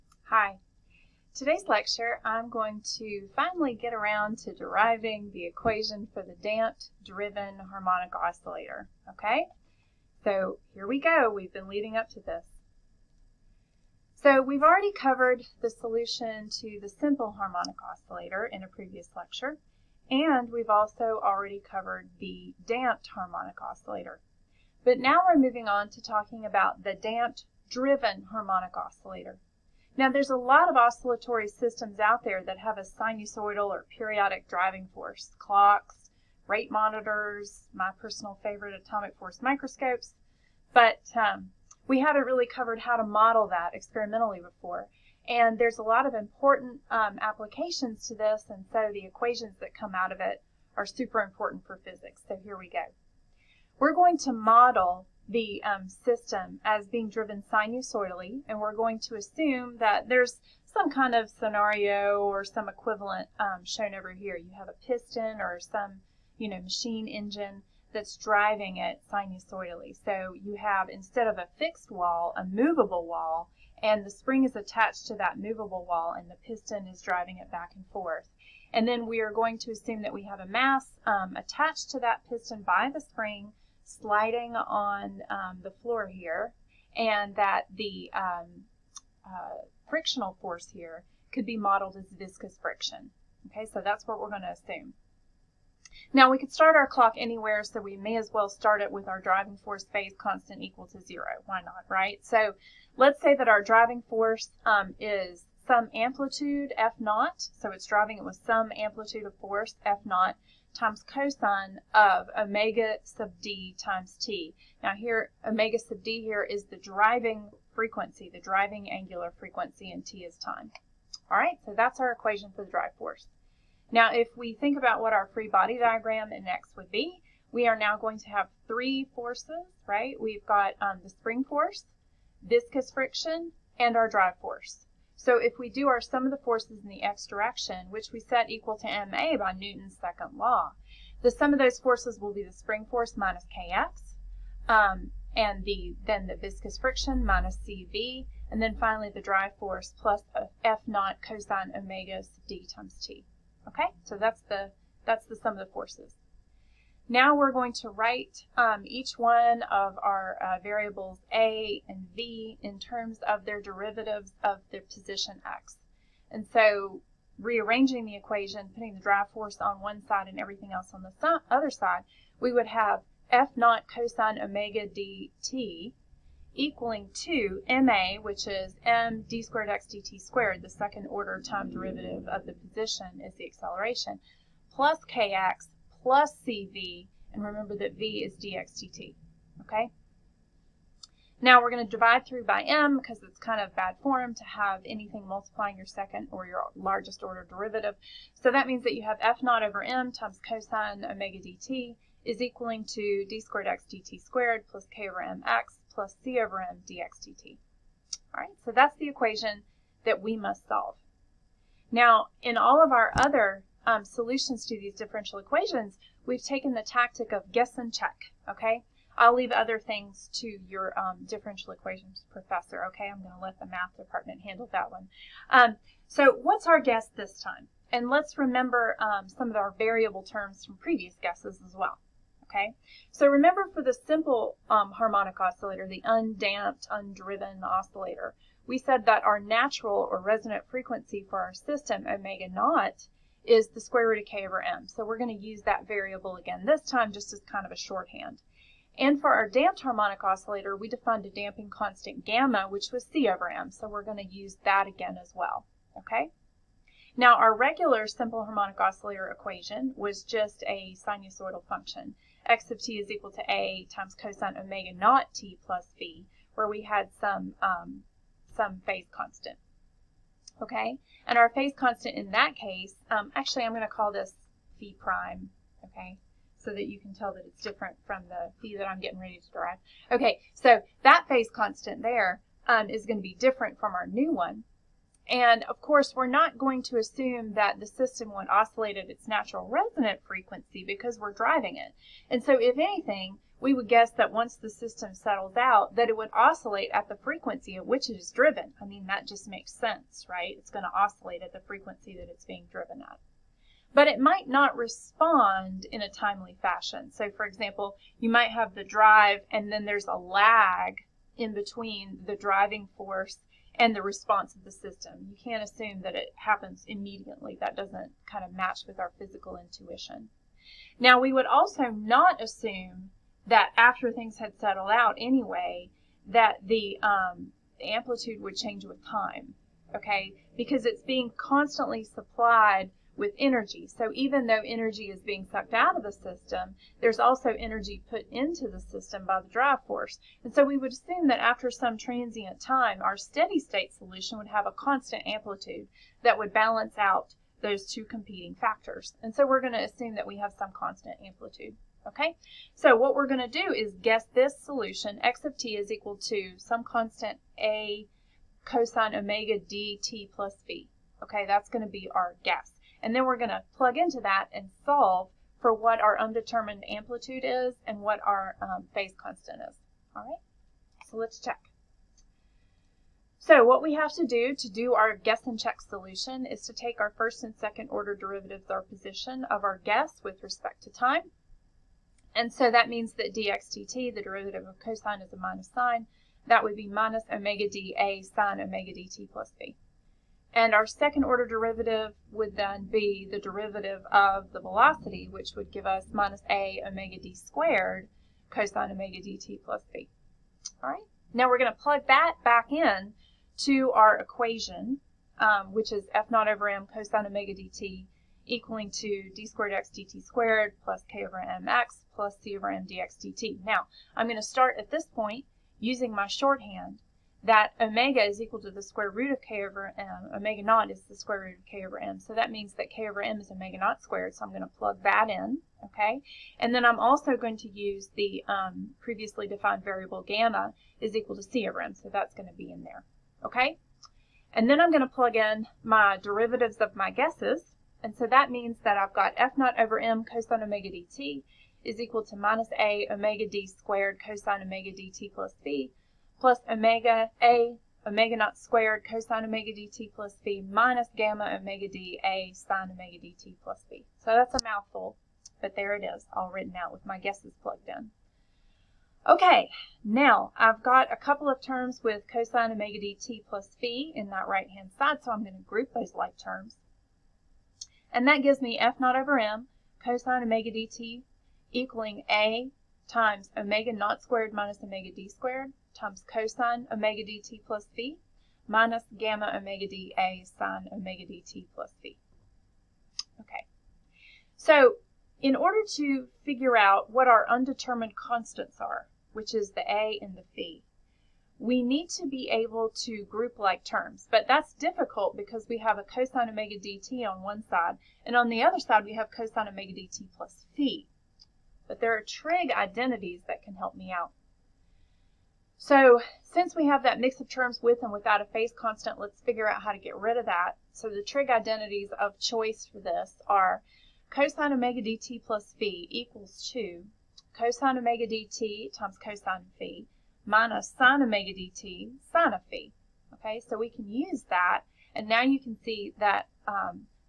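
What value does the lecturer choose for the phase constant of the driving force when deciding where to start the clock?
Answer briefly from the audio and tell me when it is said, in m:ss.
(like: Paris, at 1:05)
0, at 1:40.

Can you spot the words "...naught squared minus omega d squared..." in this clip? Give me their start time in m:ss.
7:53.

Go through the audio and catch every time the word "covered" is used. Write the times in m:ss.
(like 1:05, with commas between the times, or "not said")
0:14, 0:21, 0:42.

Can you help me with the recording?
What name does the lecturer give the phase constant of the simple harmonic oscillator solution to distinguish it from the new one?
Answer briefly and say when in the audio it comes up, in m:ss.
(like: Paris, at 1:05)
phi prime, at 4:34.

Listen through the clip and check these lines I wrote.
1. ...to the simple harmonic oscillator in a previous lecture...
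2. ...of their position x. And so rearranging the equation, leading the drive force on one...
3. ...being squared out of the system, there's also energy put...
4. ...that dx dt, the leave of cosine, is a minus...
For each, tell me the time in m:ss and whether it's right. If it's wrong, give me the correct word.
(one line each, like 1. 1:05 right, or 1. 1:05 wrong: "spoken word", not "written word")
1. 0:16 right
2. 2:44 wrong: "putting", not "leading"
3. 5:35 wrong: "sucked", not "squared"
4. 6:23 wrong: "derivative", not "leave".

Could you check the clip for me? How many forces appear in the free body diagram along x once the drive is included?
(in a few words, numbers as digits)
3.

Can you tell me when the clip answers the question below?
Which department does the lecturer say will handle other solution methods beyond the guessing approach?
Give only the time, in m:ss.
3:43.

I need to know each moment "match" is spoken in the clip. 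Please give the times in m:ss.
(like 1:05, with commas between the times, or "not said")
5:18.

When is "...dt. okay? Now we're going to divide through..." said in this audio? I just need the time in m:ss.
3:08.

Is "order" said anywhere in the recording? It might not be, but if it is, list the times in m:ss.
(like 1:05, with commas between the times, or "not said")
3:01, 3:17, 6:17, 6:31, 8:05.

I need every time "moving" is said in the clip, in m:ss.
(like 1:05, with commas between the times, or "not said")
0:25.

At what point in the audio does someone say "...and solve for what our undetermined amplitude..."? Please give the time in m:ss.
6:04.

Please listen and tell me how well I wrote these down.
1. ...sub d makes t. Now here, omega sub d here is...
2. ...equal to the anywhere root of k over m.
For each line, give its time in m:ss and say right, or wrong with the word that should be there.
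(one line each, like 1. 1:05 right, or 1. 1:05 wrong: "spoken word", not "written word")
1. 1:53 wrong: "times", not "makes"
2. 6:58 wrong: "square", not "anywhere".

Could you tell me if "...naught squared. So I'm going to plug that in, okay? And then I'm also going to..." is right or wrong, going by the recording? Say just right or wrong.
right.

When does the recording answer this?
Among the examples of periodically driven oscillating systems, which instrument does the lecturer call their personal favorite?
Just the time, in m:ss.
0:38.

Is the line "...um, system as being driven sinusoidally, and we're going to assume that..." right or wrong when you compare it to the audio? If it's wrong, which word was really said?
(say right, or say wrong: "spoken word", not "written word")
right.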